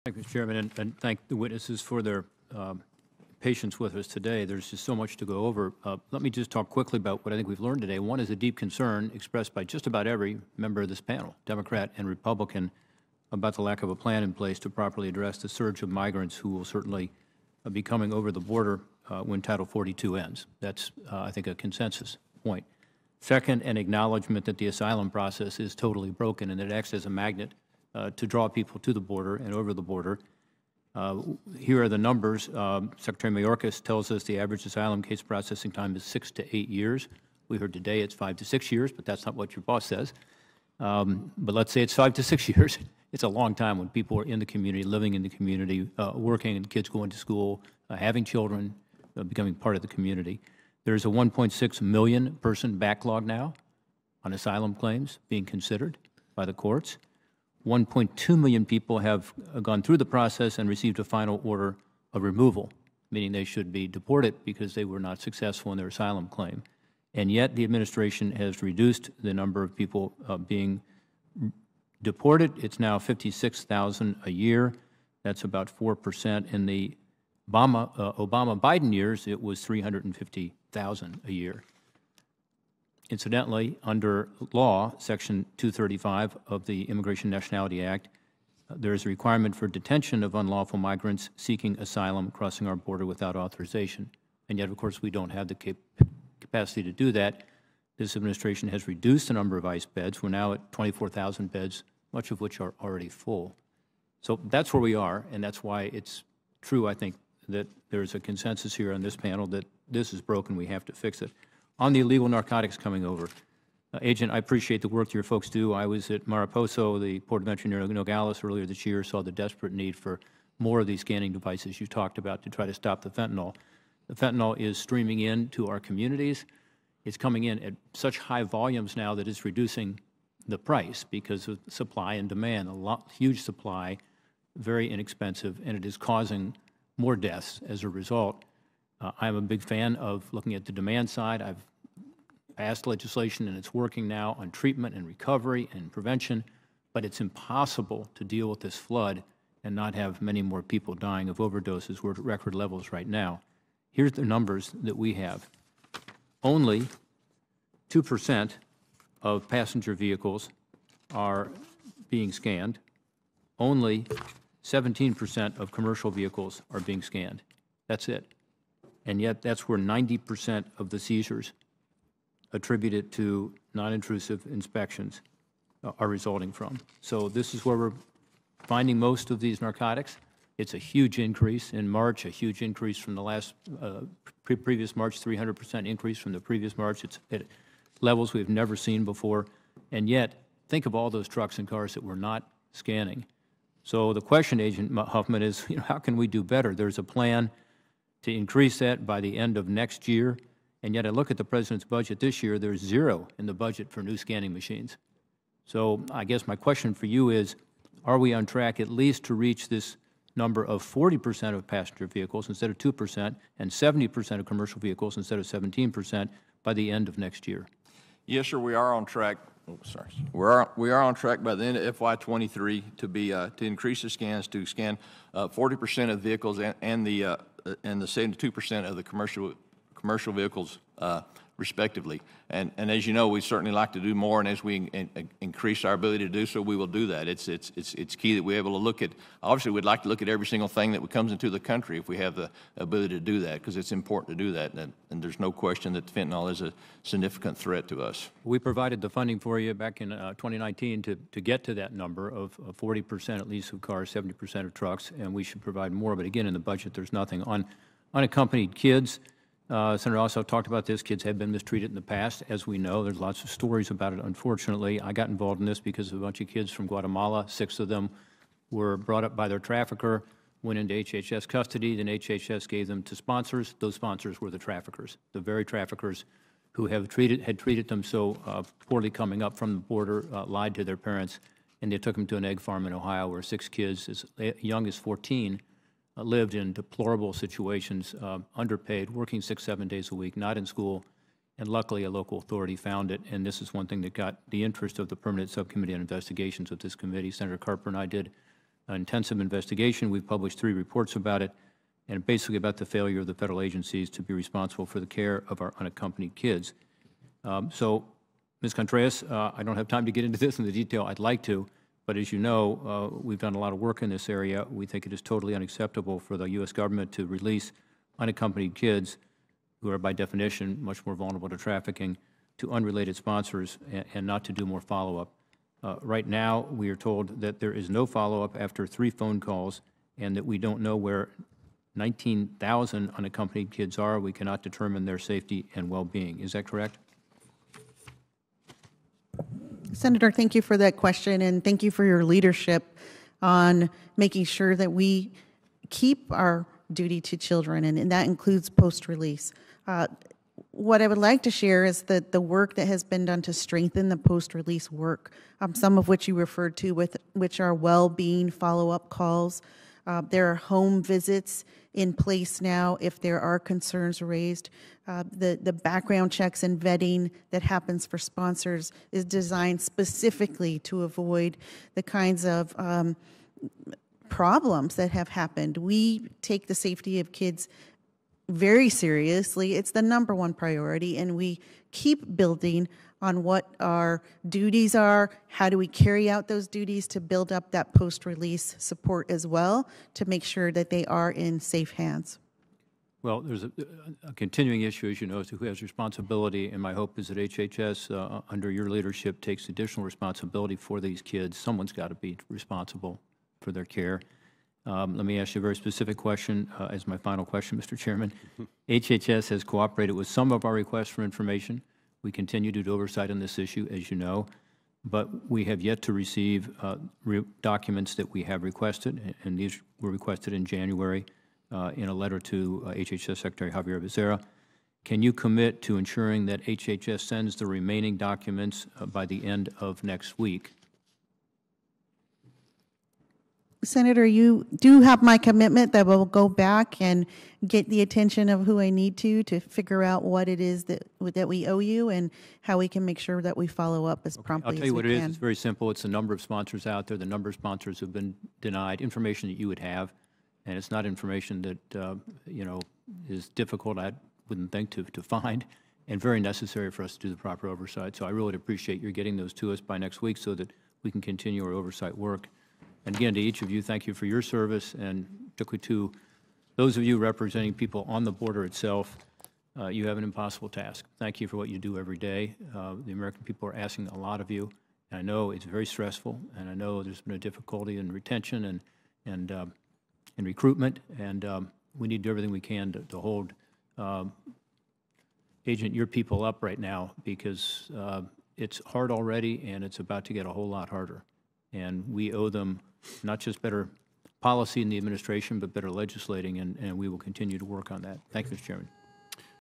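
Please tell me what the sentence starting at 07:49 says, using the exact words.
Uh, you have an impossible task.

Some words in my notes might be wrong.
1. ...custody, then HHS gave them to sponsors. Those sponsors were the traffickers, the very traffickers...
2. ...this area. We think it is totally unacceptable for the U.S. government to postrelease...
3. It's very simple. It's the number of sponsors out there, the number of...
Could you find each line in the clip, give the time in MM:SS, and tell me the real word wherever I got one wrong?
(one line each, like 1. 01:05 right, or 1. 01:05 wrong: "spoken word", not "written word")
1. 04:31 right
2. 05:14 wrong: "release", not "postrelease"
3. 07:25 right.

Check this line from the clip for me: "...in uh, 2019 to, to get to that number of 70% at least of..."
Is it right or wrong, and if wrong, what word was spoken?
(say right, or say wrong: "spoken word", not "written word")
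wrong: "40", not "70".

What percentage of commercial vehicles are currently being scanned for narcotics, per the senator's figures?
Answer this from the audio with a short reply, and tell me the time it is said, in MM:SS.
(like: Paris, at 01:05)
17%, at 02:43.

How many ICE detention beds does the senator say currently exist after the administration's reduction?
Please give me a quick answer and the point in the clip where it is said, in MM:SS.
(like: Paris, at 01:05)
24,000, at 01:40.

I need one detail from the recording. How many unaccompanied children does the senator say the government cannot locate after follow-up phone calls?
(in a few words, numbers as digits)
19,000.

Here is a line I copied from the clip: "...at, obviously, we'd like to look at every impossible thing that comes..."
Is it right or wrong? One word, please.
wrong.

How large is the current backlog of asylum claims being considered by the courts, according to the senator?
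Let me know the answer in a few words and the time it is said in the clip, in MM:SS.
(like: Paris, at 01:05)
1.6 million, at 00:51.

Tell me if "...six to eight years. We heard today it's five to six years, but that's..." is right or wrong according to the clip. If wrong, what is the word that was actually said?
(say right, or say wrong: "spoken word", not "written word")
right.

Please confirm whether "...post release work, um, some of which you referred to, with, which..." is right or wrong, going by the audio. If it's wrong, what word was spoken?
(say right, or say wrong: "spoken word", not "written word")
right.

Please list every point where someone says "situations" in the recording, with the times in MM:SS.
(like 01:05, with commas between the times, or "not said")
04:47.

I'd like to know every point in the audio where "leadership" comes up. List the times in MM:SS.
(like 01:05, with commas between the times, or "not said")
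05:42, 06:38.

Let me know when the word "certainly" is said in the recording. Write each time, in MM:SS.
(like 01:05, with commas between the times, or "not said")
00:16, 03:53.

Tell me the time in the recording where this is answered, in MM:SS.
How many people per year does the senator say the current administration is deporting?
01:12.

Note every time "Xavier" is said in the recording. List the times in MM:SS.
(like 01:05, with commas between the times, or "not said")
07:03.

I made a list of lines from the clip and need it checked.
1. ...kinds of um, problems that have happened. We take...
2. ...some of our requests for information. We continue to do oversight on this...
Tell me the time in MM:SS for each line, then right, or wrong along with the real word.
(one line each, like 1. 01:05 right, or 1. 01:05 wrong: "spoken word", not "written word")
1. 06:12 right
2. 06:50 right.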